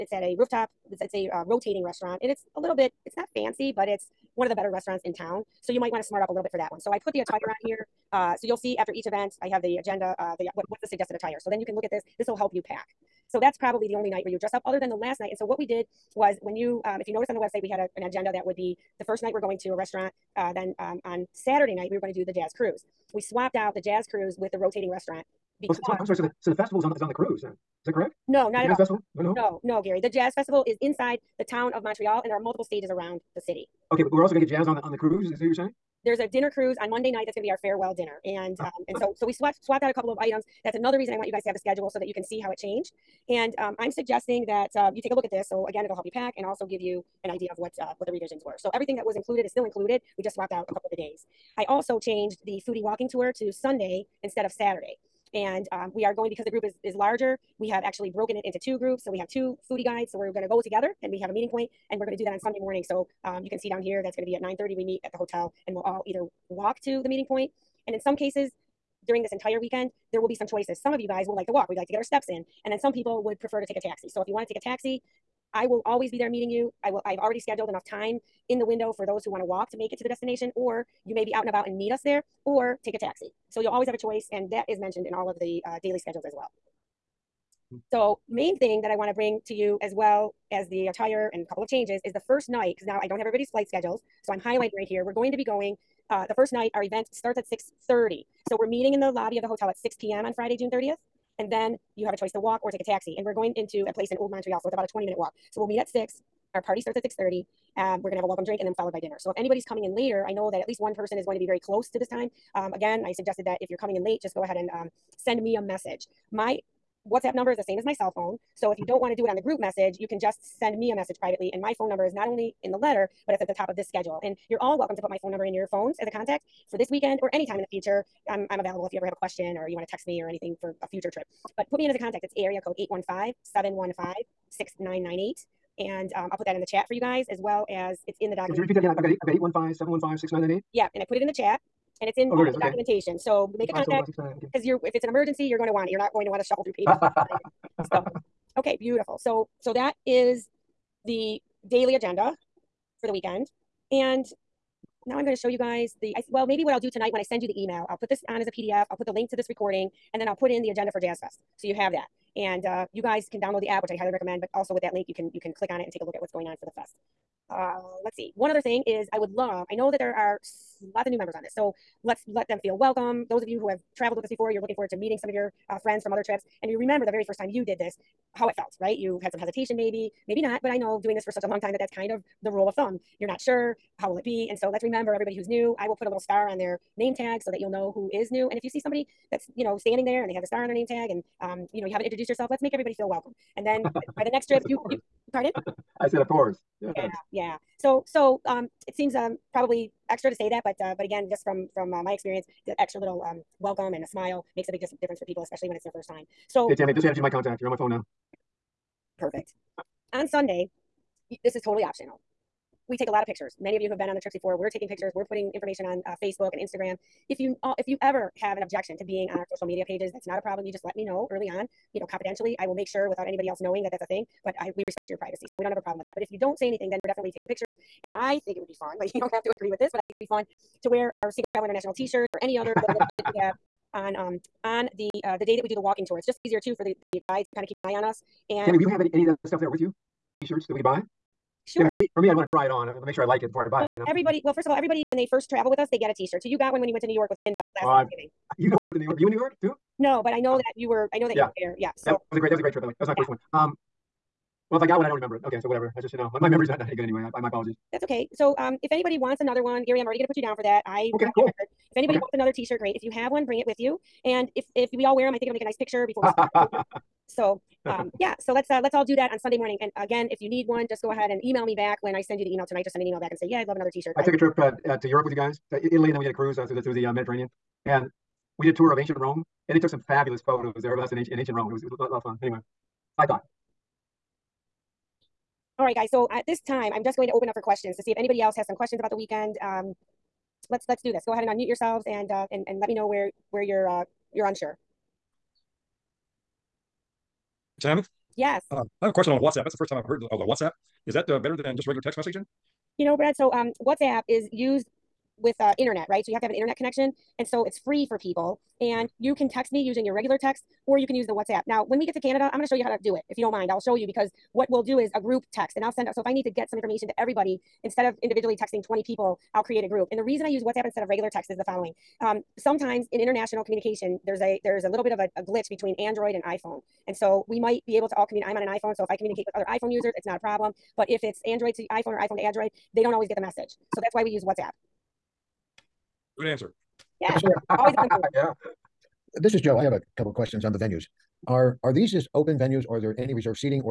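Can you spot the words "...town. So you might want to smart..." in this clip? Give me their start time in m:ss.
0:05.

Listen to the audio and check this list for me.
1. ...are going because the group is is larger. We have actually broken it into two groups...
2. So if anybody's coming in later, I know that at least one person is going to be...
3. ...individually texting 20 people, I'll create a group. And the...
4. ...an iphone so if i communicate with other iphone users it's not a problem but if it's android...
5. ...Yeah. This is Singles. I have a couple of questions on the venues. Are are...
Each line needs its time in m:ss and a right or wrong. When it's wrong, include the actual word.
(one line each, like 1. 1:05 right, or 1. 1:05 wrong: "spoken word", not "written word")
1. 0:56 right
2. 1:49 right
3. 5:18 right
4. 5:28 right
5. 5:38 wrong: "Joe", not "Singles".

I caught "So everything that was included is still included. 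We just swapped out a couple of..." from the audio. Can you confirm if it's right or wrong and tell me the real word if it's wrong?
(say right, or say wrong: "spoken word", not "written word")
right.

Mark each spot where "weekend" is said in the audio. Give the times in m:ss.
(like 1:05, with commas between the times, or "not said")
1:09, 2:06, 2:33, 4:49.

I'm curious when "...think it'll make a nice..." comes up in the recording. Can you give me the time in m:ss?
4:25.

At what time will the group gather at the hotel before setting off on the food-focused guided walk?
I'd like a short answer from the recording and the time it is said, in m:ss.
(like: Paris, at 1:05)
9:30, at 1:04.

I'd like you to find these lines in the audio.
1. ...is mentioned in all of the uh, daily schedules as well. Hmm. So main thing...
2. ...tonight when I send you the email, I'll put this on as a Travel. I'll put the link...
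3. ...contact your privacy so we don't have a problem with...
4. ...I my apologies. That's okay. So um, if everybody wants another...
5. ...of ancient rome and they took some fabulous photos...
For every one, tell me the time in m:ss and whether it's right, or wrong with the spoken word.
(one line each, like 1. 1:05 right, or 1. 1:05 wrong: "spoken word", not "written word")
1. 1:24 right
2. 2:36 wrong: "PDF", not "Travel"
3. 3:44 wrong: "respect", not "contact"
4. 4:17 wrong: "anybody", not "everybody"
5. 4:38 right.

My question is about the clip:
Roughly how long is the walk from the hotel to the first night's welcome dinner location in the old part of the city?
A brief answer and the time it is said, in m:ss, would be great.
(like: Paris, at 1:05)
20 minutes, at 1:44.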